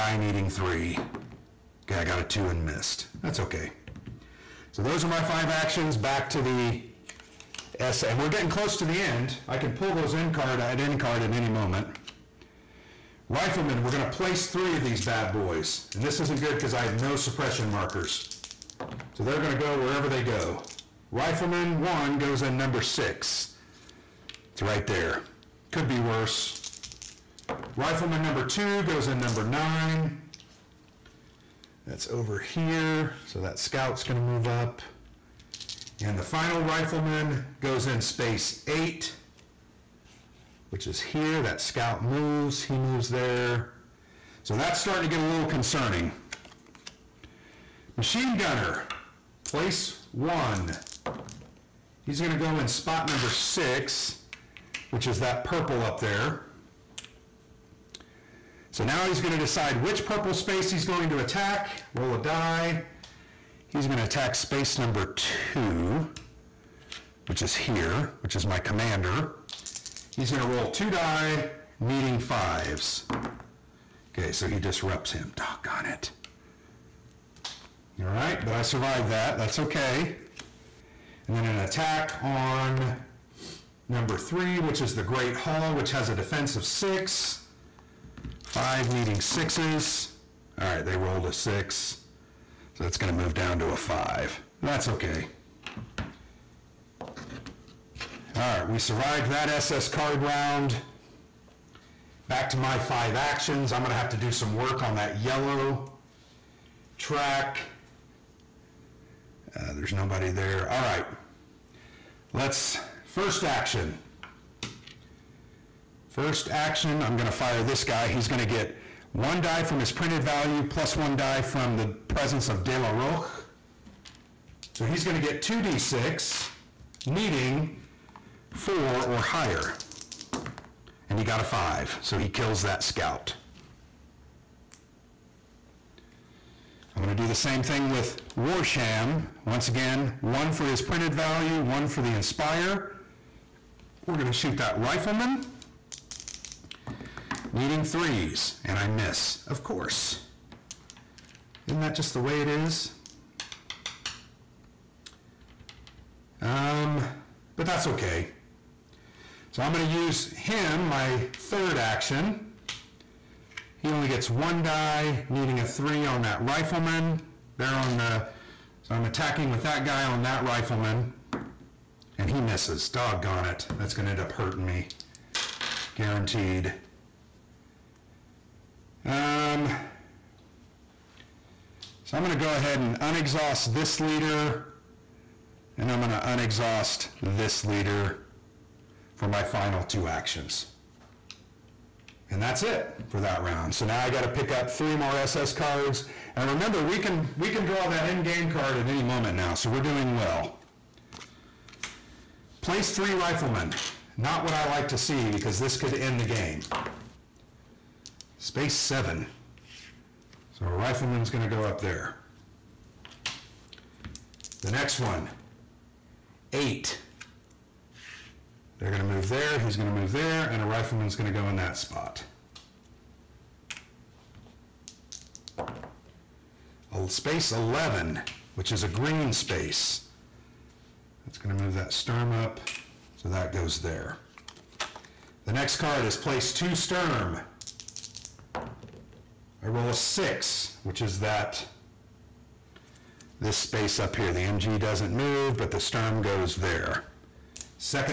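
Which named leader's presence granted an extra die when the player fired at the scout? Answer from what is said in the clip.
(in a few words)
De La Rocque.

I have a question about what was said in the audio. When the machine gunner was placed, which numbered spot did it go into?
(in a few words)
6.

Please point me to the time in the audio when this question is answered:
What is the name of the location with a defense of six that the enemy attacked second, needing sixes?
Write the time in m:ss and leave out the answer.
1:24.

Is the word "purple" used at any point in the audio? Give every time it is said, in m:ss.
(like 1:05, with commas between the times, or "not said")
0:55, 1:00.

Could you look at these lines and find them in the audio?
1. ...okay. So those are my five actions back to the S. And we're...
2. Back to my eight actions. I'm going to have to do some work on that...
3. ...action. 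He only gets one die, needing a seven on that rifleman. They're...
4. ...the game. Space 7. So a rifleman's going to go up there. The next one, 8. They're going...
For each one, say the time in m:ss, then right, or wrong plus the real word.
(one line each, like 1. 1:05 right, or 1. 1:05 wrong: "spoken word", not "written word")
1. 0:03 right
2. 1:42 wrong: "five", not "eight"
3. 2:41 wrong: "three", not "seven"
4. 3:26 right.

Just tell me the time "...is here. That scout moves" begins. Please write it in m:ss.
0:40.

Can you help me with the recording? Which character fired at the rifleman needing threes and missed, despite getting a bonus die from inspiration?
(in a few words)
Warsham.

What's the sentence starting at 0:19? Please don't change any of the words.
So they're going to go wherever they go.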